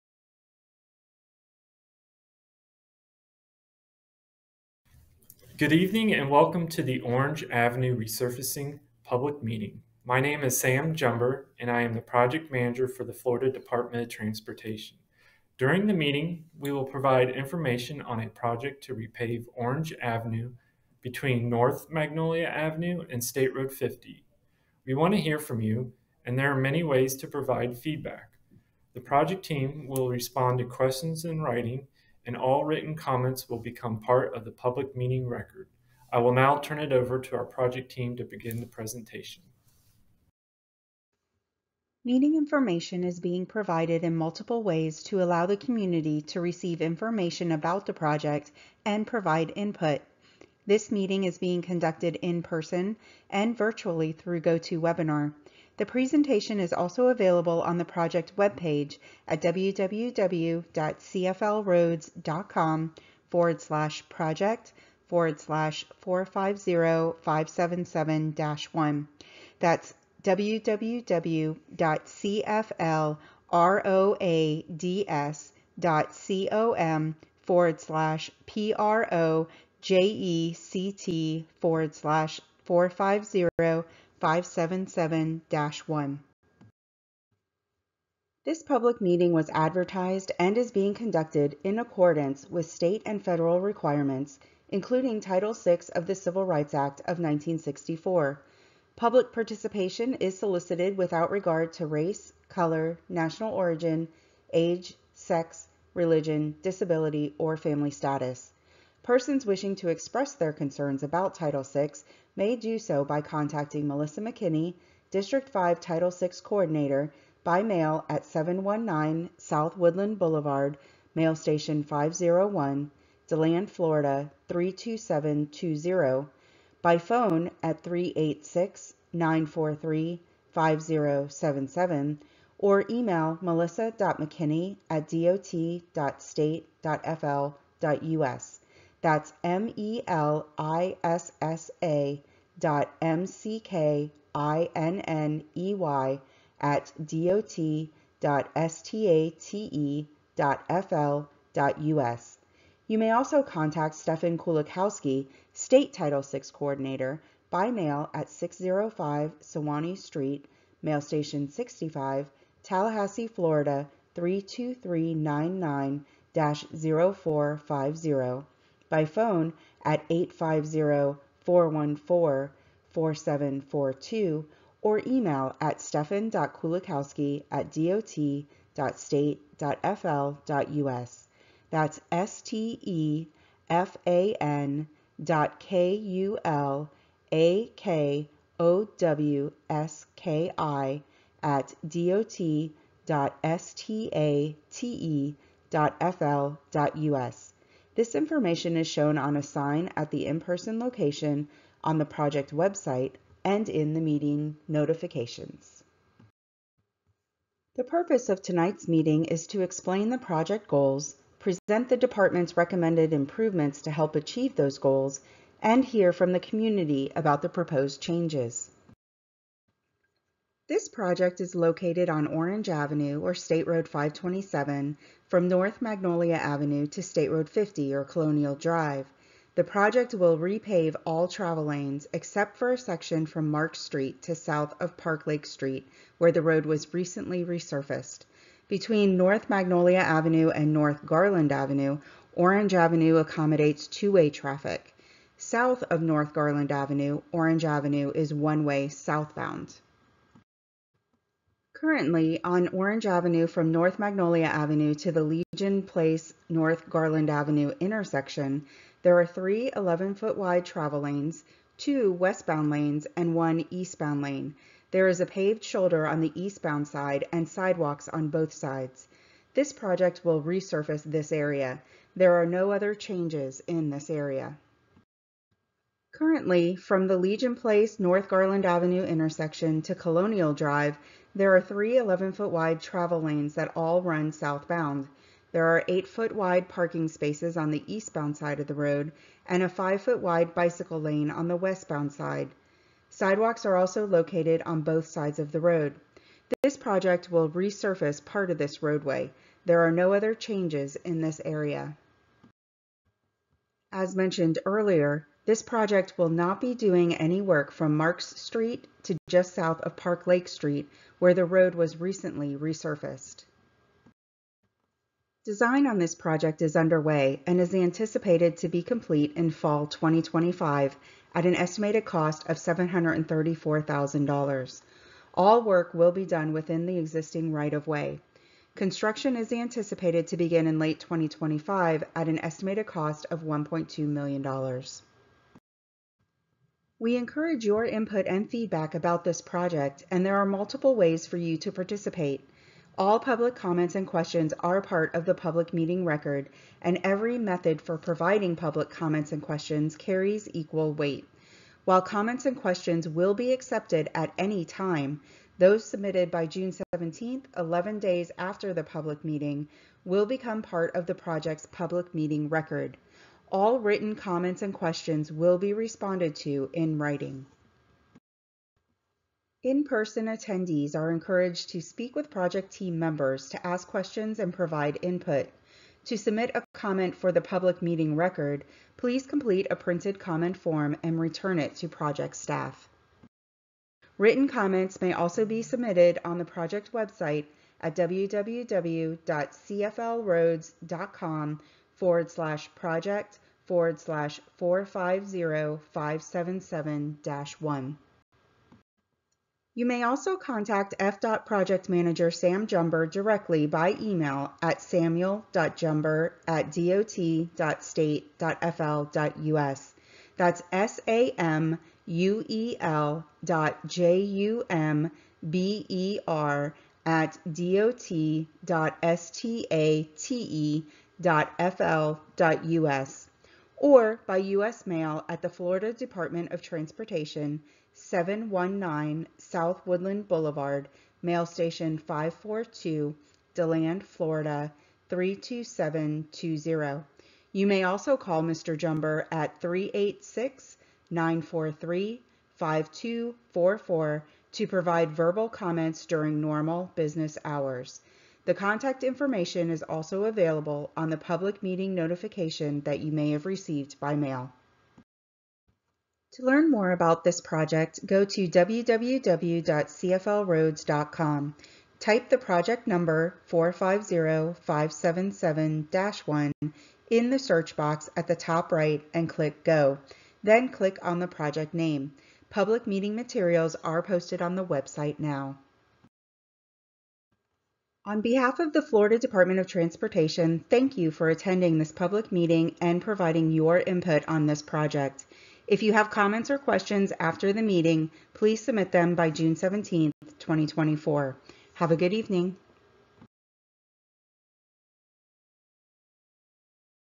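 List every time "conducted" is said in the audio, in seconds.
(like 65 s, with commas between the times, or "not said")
51 s, 90 s.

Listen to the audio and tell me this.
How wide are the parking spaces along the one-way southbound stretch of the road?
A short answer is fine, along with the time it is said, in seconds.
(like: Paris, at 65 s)
8-foot, at 285 s.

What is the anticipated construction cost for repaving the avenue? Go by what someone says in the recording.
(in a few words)
$1.2 million.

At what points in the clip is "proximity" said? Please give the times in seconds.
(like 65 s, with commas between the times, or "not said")
not said.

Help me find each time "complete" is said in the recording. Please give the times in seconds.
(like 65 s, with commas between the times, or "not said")
318 s, 379 s.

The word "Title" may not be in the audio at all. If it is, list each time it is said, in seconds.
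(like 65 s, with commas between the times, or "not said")
95 s, 111 s, 115 s, 155 s.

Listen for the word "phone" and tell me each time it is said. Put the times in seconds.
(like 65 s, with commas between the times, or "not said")
126 s, 169 s.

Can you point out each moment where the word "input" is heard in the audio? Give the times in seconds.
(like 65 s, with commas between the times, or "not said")
49 s, 337 s, 375 s, 483 s.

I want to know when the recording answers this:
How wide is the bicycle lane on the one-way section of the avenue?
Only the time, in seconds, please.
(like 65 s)
289 s.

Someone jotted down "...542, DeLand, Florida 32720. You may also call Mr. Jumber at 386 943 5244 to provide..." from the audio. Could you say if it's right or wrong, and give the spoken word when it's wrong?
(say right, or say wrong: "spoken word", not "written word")
right.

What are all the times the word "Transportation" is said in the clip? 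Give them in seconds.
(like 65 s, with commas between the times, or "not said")
14 s, 426 s, 479 s.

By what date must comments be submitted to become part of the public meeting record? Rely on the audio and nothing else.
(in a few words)
June 17.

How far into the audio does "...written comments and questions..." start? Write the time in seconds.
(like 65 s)
363 s.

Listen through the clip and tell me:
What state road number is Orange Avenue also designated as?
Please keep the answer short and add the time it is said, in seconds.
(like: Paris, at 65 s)
State Road 527, at 223 s.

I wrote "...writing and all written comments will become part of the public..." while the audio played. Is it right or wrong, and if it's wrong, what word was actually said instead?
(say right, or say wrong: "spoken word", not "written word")
right.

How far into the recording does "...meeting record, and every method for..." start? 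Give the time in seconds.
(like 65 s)
345 s.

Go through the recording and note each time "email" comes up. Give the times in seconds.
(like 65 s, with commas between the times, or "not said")
132 s, 175 s, 404 s.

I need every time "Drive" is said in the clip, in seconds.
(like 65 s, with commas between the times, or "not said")
228 s, 280 s.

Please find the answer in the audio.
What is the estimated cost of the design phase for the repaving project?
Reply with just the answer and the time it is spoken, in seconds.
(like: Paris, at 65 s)
$734,000, at 322 s.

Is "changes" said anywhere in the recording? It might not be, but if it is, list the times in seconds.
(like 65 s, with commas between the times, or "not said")
217 s, 272 s, 300 s.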